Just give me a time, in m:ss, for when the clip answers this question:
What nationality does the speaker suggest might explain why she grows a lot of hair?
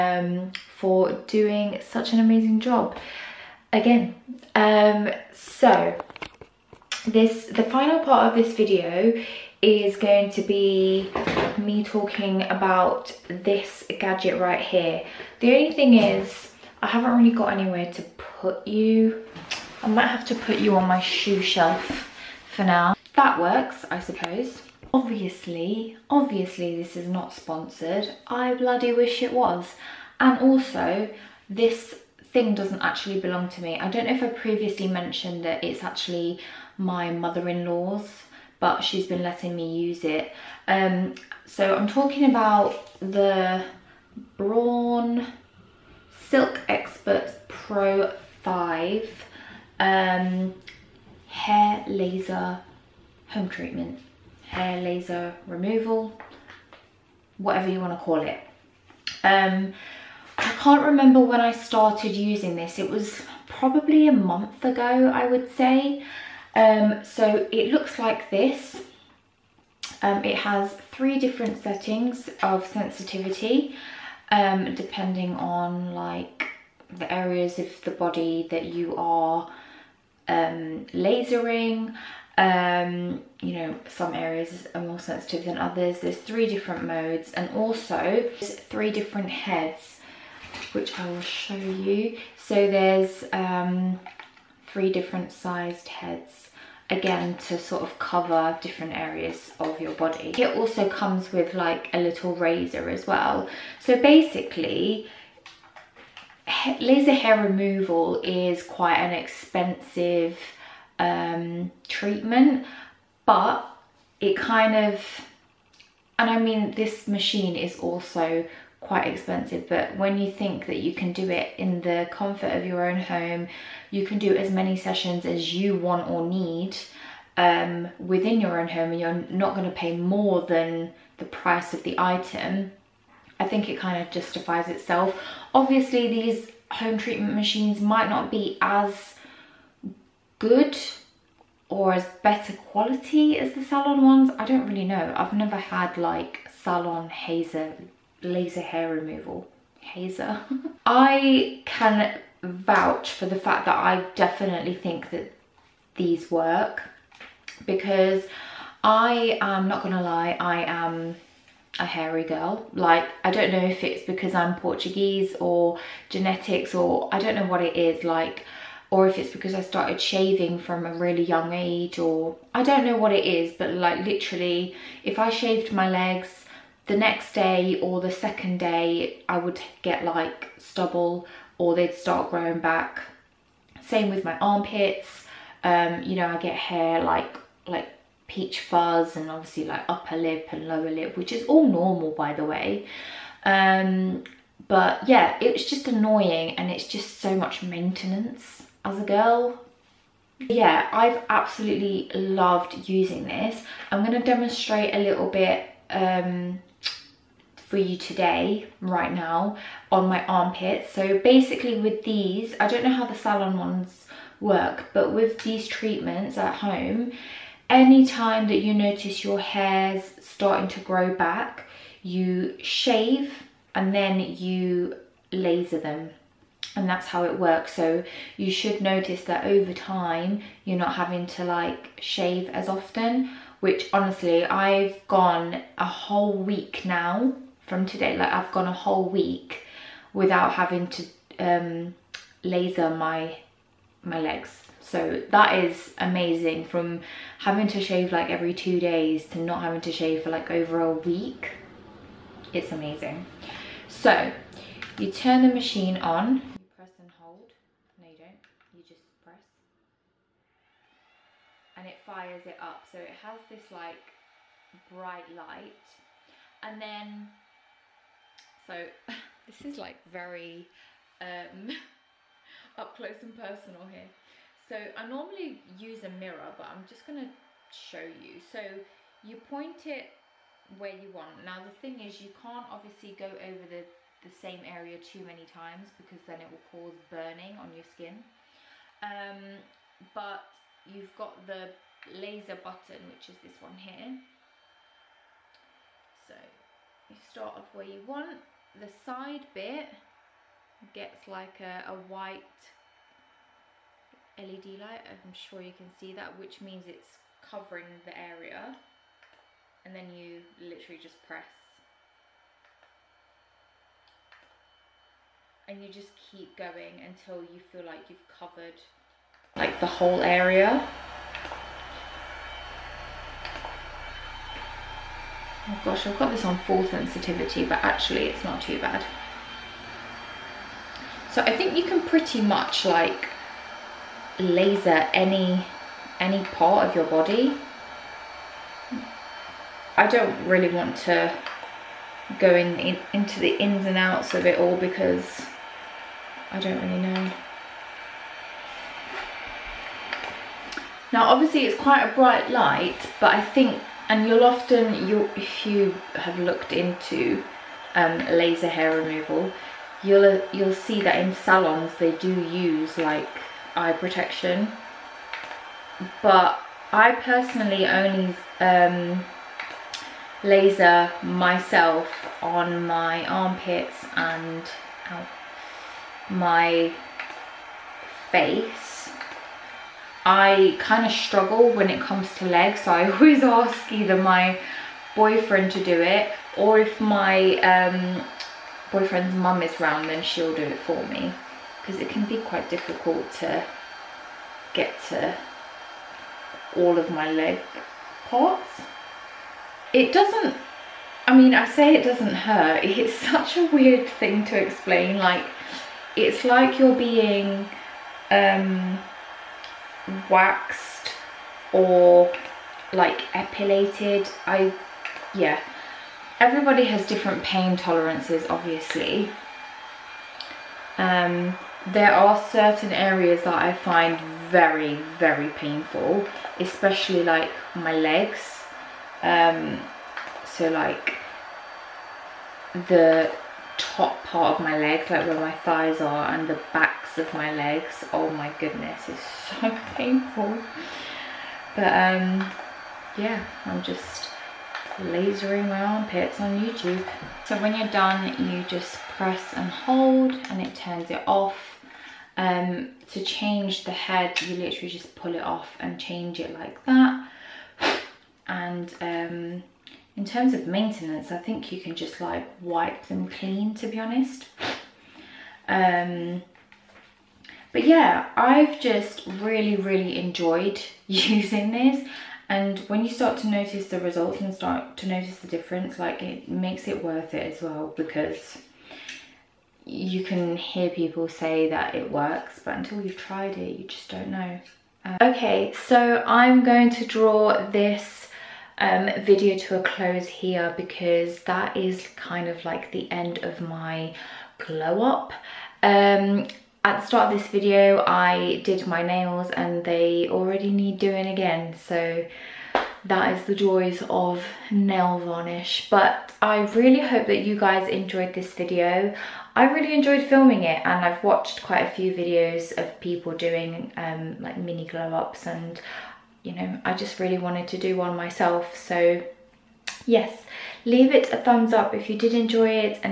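2:44.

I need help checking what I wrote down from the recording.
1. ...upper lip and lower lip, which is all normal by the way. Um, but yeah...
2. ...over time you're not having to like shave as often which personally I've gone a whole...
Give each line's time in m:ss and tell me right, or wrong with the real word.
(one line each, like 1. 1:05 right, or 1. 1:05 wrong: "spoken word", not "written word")
1. 3:09 right
2. 3:49 wrong: "honestly", not "personally".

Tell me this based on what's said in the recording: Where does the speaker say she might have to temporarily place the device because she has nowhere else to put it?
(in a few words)
Shoe shelf.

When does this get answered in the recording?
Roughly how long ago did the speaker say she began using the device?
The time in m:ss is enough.
1:04.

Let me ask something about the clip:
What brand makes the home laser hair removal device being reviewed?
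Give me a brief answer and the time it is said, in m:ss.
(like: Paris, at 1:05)
Braun, at 0:44.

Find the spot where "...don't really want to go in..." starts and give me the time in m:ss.
5:40.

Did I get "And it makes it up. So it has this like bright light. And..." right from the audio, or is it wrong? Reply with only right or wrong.
wrong.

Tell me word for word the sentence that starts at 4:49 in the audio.
Um, but you've got the laser button, which is this one here.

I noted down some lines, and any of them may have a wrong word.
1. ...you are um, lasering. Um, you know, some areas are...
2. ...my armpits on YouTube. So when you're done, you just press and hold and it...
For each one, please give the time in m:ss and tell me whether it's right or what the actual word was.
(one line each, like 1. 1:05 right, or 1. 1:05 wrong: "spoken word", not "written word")
1. 1:18 right
2. 7:25 right.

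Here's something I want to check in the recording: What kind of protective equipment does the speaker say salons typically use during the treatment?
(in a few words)
Eye protection.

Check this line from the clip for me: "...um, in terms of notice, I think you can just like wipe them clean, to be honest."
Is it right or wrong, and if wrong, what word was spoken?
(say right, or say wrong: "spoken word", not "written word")
wrong: "maintenance", not "notice".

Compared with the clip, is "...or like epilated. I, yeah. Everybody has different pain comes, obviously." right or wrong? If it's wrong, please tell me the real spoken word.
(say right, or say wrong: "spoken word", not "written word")
wrong: "tolerances", not "comes".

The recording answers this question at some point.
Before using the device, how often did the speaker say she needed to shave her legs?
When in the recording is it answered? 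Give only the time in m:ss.
4:08.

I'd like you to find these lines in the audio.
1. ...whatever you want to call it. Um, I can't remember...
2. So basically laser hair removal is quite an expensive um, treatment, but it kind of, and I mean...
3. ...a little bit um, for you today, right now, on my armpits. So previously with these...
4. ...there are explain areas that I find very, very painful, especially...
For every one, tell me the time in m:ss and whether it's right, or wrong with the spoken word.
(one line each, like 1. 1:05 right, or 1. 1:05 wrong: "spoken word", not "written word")
1. 0:57 right
2. 1:43 right
3. 3:24 wrong: "basically", not "previously"
4. 7:01 wrong: "certain", not "explain".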